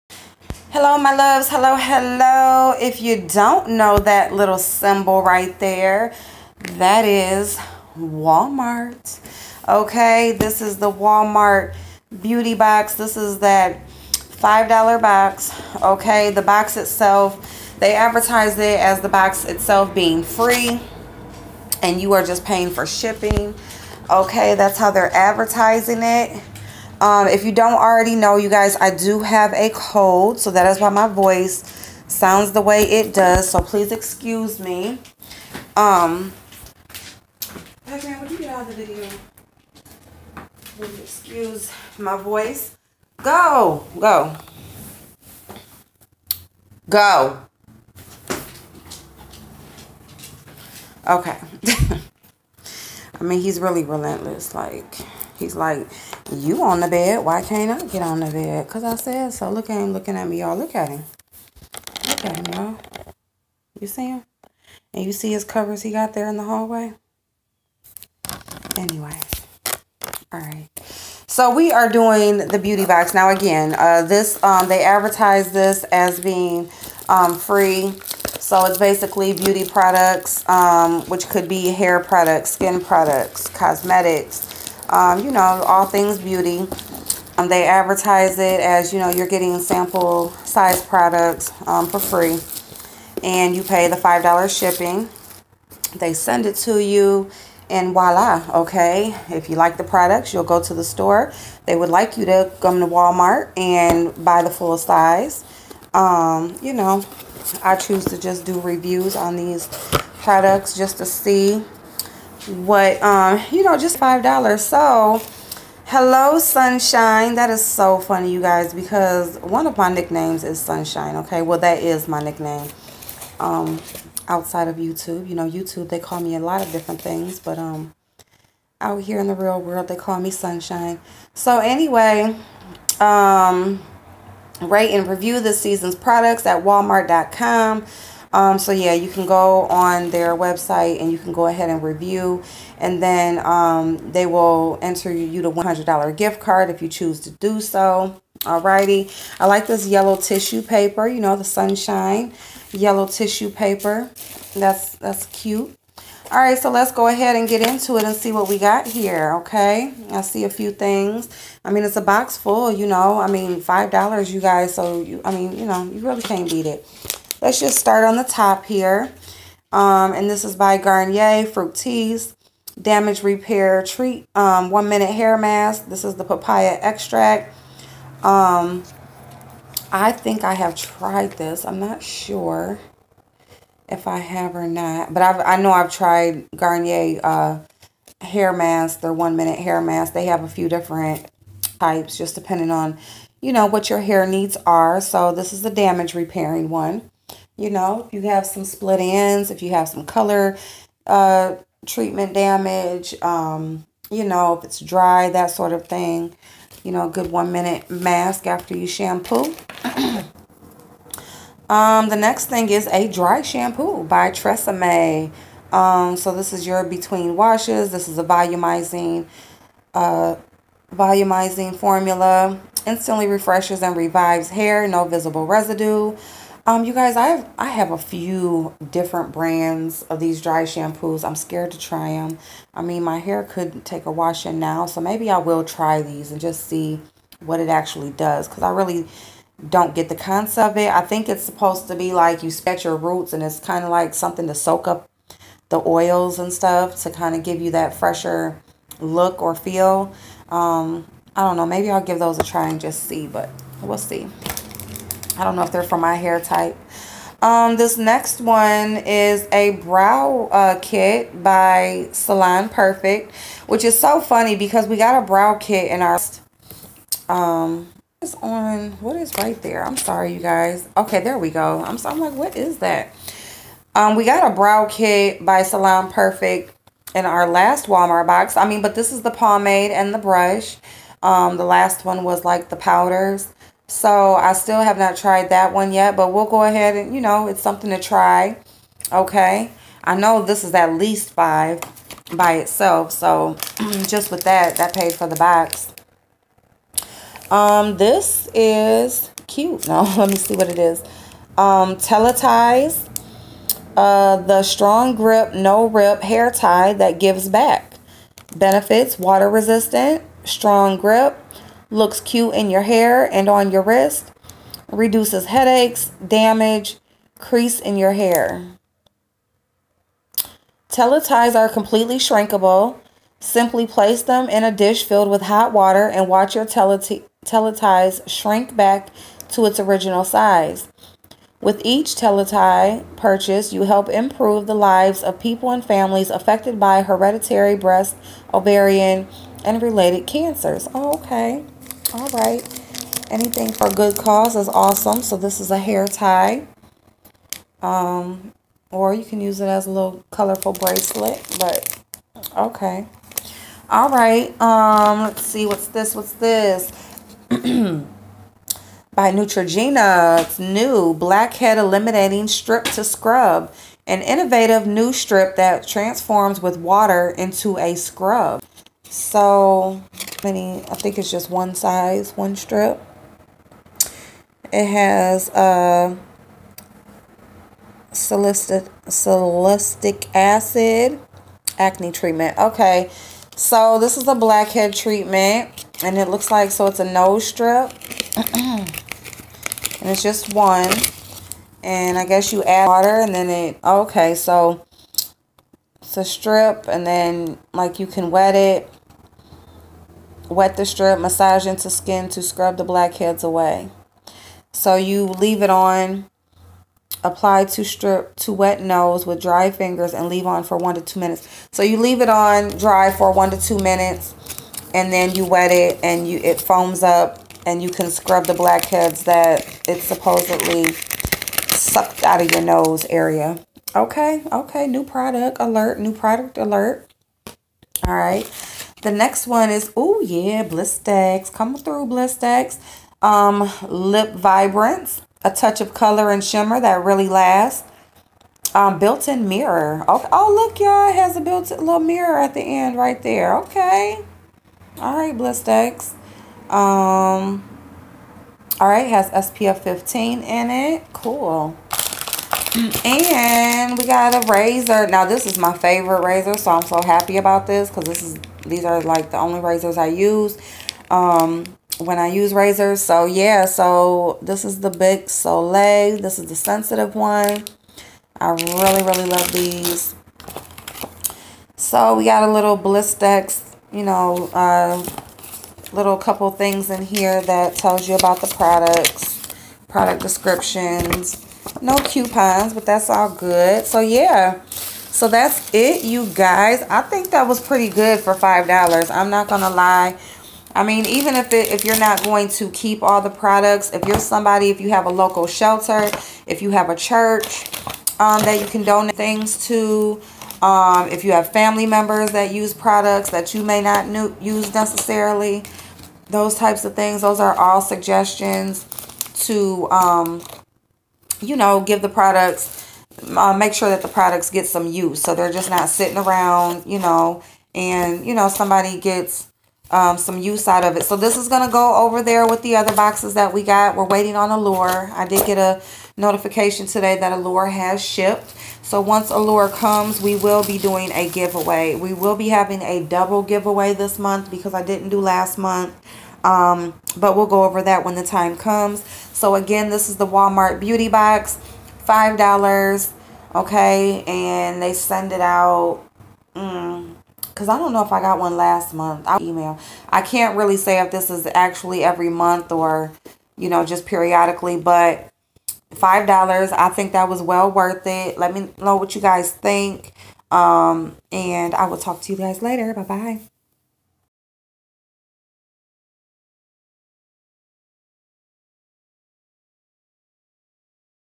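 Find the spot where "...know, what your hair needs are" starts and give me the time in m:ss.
3:13.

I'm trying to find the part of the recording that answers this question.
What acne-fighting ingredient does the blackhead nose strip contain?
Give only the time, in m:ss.
6:18.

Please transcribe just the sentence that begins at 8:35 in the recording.
So they're just not sitting around, you know, and, you know, somebody gets um, some use out of it.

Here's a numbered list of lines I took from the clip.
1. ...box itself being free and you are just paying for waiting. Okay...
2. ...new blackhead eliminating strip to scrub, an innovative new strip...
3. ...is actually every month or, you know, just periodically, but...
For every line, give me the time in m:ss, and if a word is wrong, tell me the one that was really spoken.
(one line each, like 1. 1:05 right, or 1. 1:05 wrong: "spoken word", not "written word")
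1. 0:19 wrong: "shipping", not "waiting"
2. 6:00 right
3. 9:11 right.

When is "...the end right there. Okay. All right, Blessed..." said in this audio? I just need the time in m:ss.
7:22.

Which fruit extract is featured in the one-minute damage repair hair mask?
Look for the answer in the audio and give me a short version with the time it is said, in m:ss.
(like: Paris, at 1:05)
papaya, at 2:56.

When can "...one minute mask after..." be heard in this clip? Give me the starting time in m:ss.
3:27.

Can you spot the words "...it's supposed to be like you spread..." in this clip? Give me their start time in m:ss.
4:01.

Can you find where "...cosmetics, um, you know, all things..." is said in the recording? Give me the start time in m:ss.
1:23.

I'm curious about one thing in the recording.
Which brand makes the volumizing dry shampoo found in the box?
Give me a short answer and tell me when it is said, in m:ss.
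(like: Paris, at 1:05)
Tresemme, at 3:34.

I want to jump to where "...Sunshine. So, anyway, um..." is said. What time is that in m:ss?
2:10.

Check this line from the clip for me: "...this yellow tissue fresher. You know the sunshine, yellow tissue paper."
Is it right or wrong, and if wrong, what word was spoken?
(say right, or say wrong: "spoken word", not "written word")
wrong: "paper", not "fresher".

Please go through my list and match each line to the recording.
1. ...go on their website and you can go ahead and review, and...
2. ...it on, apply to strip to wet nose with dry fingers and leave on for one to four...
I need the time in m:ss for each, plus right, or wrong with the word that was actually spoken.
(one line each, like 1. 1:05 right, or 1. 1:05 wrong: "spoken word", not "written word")
1. 2:19 right
2. 6:45 wrong: "two", not "four".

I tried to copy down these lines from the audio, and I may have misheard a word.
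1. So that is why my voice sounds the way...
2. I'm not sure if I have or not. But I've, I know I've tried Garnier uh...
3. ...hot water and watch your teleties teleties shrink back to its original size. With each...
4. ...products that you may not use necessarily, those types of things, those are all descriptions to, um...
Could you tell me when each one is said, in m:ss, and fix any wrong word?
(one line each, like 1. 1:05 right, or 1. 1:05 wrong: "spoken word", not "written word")
1. 0:30 right
2. 3:01 right
3. 5:25 right
4. 8:22 wrong: "suggestions", not "descriptions".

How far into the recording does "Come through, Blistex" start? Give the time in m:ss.
7:11.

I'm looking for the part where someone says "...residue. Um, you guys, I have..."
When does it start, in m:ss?
3:45.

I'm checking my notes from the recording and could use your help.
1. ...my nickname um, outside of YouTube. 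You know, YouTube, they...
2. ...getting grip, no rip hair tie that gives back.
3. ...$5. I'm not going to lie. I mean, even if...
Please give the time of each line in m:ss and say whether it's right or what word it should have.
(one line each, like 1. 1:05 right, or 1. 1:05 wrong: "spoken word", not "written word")
1. 2:02 right
2. 5:04 wrong: "strong", not "getting"
3. 8:08 right.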